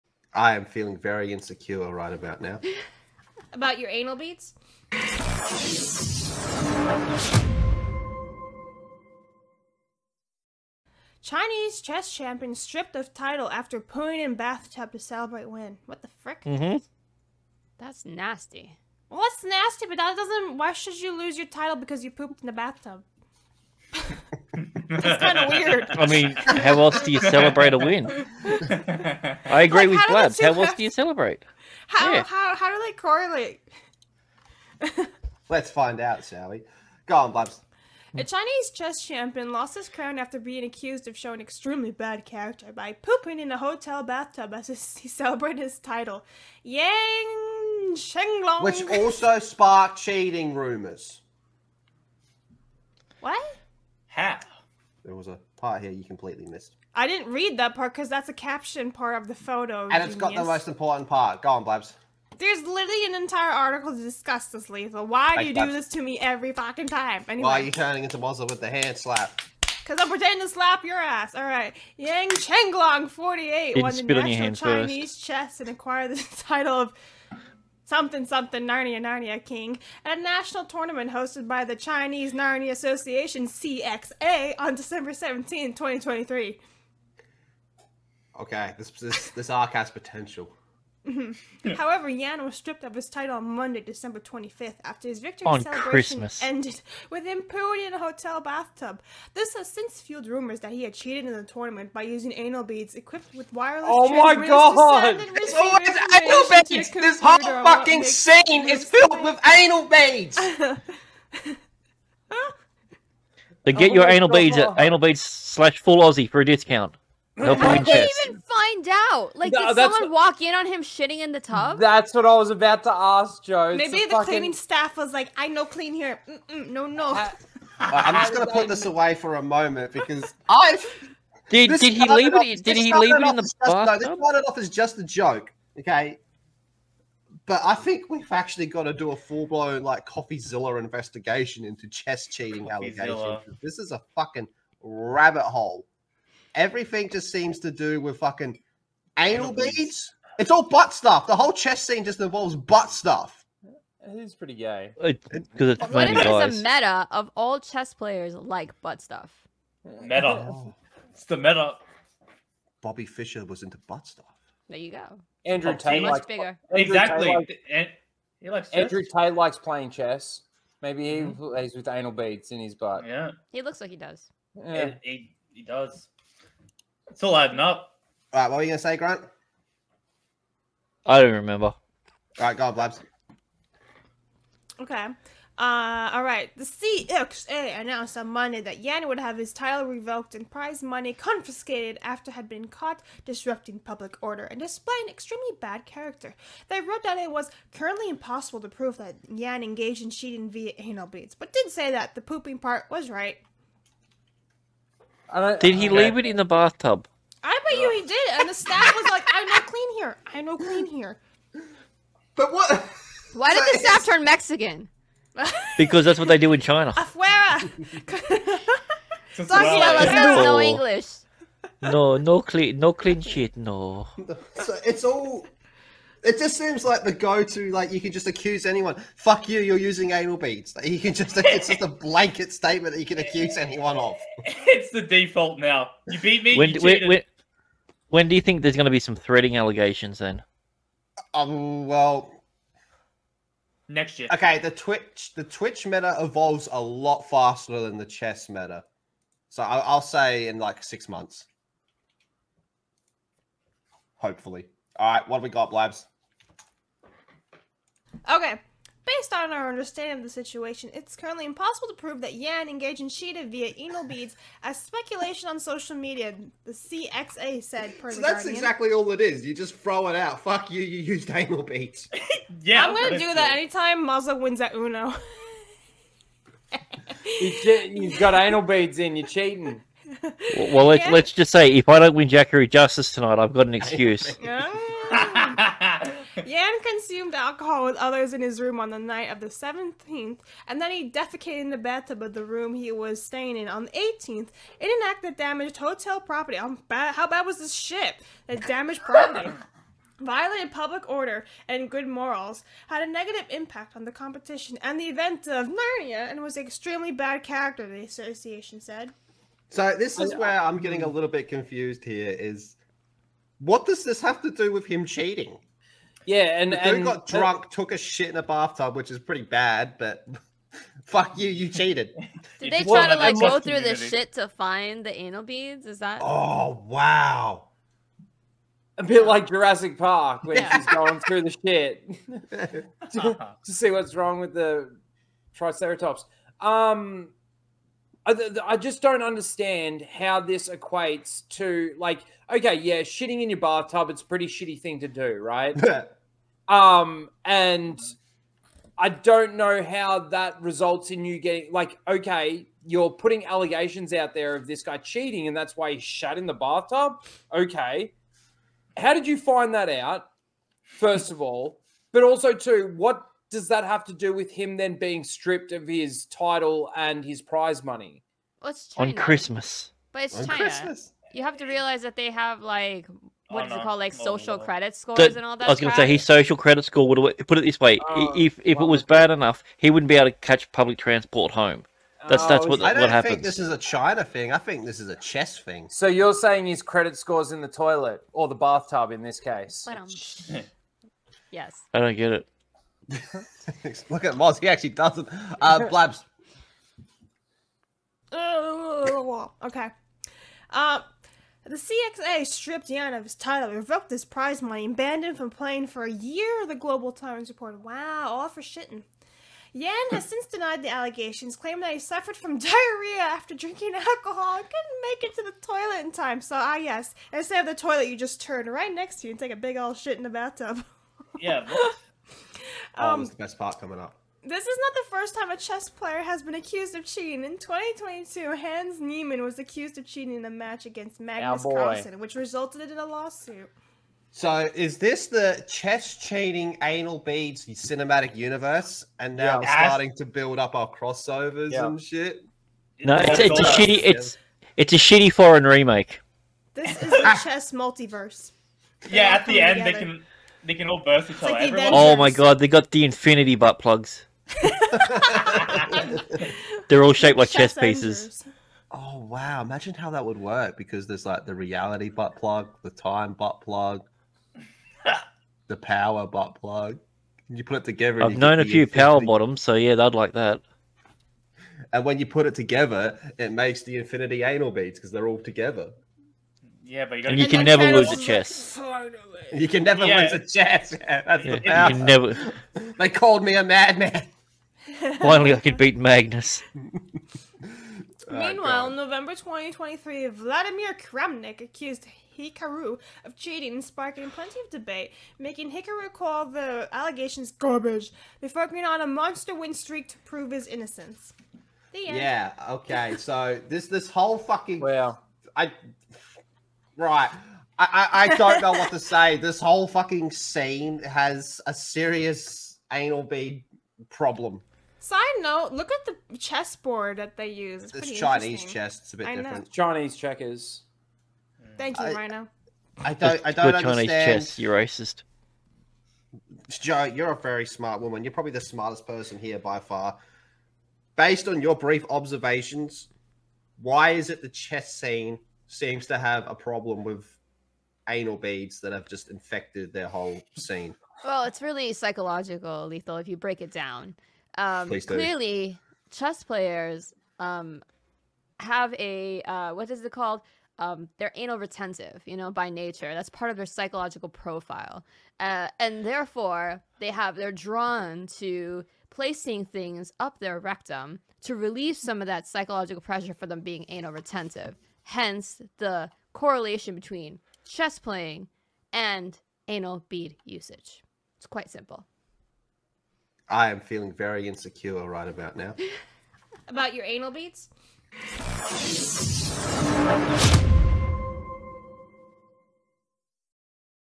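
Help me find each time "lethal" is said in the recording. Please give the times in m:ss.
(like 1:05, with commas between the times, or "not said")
1:04, 9:02.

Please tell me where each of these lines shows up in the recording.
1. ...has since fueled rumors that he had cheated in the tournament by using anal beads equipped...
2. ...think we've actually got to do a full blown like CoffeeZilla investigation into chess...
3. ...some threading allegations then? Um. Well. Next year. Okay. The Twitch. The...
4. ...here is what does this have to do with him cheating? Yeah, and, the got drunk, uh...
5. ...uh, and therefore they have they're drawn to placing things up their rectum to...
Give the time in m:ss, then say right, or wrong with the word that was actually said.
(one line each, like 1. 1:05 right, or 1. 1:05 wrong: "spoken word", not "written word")
1. 1:39 right
2. 2:17 right
3. 3:58 right
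4. 5:12 right
5. 9:15 right.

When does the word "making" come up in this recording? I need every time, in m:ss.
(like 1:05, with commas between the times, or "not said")
8:15.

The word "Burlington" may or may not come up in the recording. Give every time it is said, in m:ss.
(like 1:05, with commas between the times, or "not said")
not said.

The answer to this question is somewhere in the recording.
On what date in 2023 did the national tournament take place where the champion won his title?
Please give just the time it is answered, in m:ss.
1:24.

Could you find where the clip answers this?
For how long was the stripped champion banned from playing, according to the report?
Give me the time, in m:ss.
6:46.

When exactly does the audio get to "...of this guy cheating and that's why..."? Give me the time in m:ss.
5:54.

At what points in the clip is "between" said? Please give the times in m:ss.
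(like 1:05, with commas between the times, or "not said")
9:26.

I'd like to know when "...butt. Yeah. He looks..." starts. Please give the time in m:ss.
2:52.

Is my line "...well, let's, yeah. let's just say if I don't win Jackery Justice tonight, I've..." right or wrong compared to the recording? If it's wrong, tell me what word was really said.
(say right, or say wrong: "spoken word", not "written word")
right.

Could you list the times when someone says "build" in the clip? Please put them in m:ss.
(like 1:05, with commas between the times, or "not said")
7:20.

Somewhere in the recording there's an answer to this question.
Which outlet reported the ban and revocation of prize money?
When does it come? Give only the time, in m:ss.
6:46.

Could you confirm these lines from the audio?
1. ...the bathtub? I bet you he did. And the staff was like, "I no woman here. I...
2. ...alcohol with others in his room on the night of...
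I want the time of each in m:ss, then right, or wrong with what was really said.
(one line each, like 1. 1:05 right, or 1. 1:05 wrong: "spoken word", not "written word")
1. 3:26 wrong: "clean", not "woman"
2. 4:47 right.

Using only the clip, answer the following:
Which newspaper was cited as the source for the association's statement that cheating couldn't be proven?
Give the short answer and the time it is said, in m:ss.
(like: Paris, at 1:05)
Guardian, at 4:28.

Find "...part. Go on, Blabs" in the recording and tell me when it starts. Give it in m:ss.
1:01.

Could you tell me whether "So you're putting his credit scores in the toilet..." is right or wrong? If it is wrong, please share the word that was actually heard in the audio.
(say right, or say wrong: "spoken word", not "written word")
wrong: "saying", not "putting".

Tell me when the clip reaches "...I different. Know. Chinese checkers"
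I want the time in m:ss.
8:39.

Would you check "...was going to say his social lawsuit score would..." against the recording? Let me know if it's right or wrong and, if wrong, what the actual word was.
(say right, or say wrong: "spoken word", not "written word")
wrong: "credit", not "lawsuit".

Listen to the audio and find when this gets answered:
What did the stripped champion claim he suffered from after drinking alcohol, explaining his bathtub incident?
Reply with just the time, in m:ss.
6:52.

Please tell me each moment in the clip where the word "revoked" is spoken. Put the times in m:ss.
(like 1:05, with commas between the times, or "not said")
3:09, 6:43.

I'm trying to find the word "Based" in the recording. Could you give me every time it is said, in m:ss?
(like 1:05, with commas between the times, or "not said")
4:19, 8:51.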